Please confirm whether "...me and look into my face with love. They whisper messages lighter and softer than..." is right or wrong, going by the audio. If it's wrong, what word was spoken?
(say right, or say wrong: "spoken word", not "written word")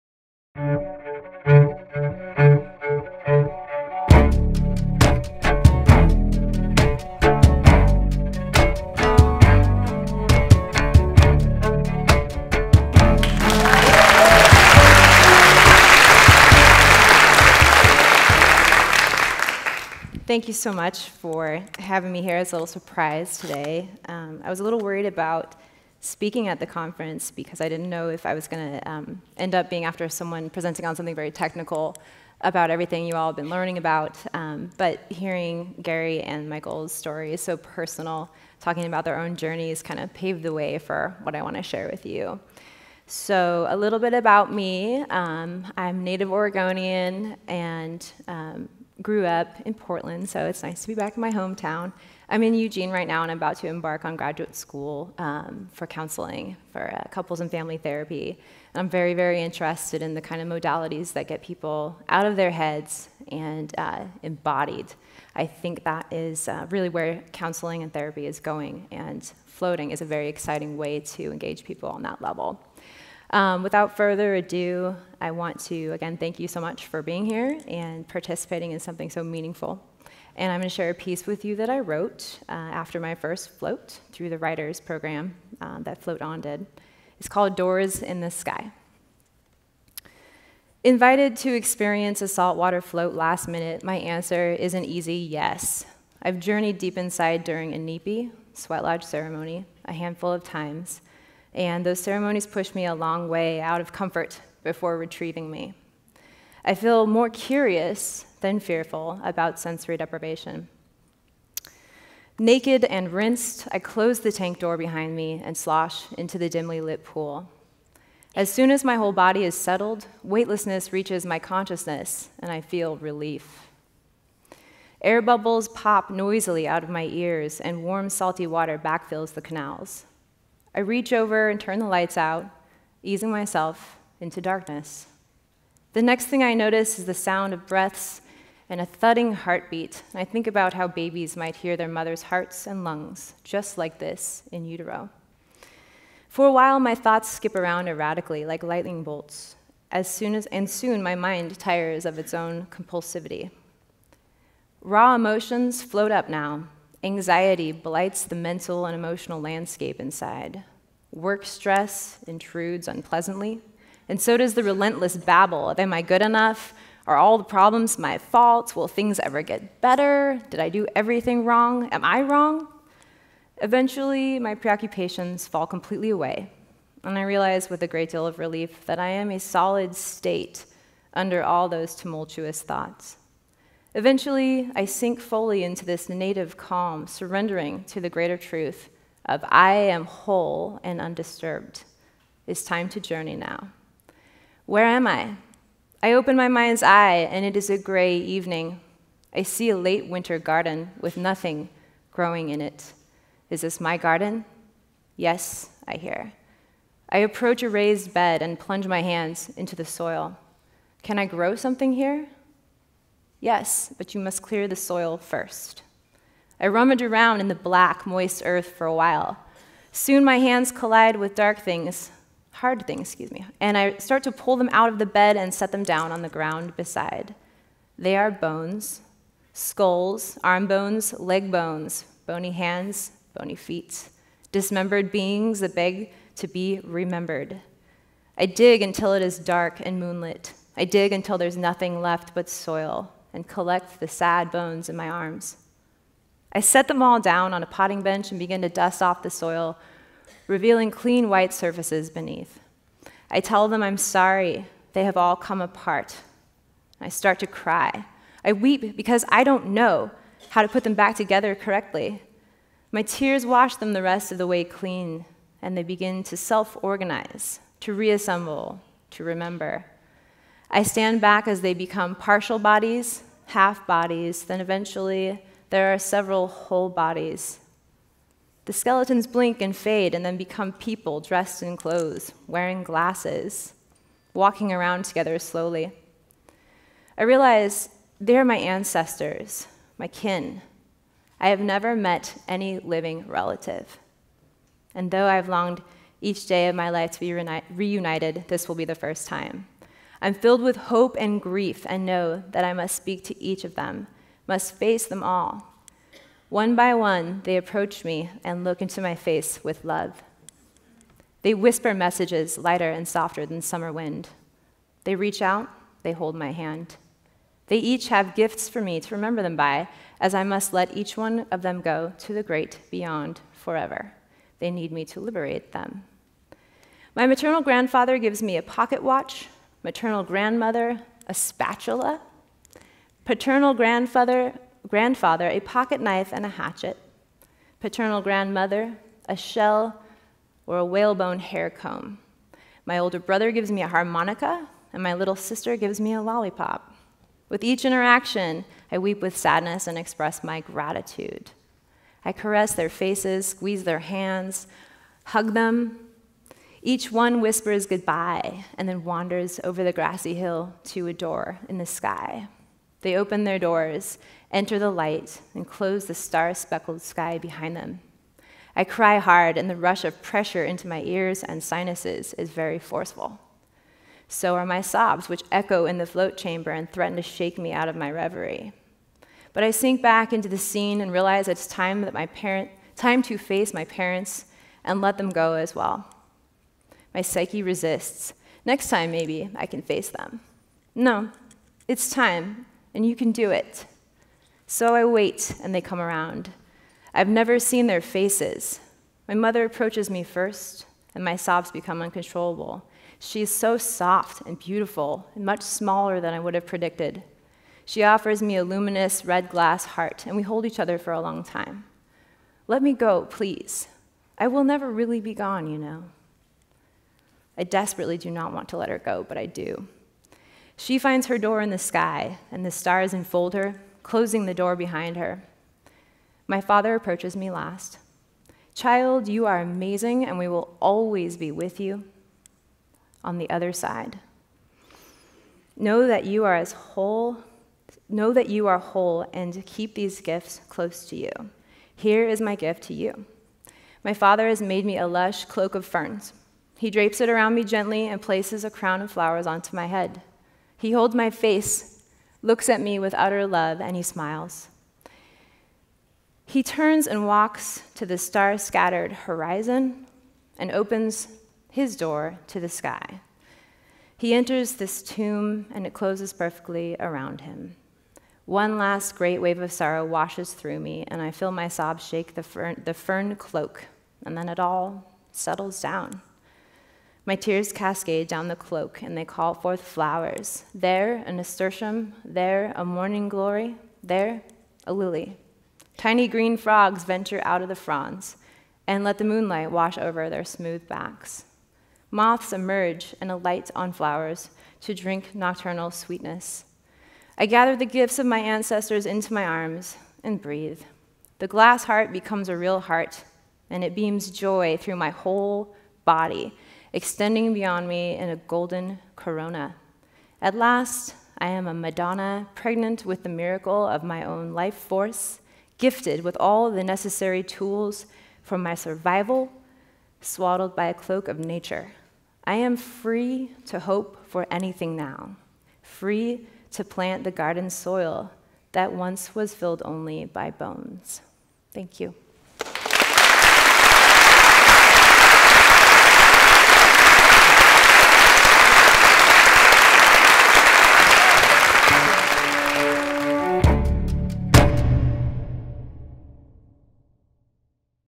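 right.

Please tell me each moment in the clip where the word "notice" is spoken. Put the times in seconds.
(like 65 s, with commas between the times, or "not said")
136 s.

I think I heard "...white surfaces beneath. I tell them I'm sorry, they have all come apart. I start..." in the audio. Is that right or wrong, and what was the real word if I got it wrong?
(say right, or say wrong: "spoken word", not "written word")
right.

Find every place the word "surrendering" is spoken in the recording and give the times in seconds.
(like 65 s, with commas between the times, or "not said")
187 s.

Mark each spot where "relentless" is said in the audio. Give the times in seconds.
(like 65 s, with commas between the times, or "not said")
164 s.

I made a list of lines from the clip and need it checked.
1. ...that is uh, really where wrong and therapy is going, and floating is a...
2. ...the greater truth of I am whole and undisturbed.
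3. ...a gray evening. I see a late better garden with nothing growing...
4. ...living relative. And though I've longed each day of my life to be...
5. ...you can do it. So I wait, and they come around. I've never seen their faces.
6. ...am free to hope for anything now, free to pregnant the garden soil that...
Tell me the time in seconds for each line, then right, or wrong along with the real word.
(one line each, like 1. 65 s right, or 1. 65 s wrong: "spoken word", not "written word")
1. 65 s wrong: "counseling", not "wrong"
2. 187 s right
3. 197 s wrong: "winter", not "better"
4. 292 s right
5. 393 s right
6. 522 s wrong: "plant", not "pregnant".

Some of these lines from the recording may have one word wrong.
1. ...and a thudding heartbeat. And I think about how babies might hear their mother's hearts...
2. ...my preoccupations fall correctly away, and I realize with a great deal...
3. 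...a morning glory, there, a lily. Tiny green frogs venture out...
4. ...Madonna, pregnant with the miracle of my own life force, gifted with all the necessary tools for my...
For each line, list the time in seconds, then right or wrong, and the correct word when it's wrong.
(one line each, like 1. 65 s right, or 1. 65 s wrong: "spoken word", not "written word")
1. 138 s right
2. 174 s wrong: "completely", not "correctly"
3. 482 s right
4. 511 s right.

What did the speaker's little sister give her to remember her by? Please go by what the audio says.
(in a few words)
a lollipop.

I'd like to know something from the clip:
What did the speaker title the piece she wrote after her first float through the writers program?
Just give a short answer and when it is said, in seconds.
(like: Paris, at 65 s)
Doors in the Sky, at 87 s.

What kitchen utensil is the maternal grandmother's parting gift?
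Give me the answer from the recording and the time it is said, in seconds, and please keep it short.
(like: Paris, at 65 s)
a spatula, at 331 s.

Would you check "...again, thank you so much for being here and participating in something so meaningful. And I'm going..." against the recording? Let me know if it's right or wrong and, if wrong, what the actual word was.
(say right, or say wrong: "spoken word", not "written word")
right.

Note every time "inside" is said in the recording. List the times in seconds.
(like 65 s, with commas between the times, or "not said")
96 s, 159 s.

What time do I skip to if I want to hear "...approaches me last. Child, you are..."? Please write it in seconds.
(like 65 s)
426 s.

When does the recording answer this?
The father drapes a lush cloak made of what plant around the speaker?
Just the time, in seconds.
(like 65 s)
445 s.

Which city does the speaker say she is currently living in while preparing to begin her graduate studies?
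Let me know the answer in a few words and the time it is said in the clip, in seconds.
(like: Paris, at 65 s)
Eugene, at 52 s.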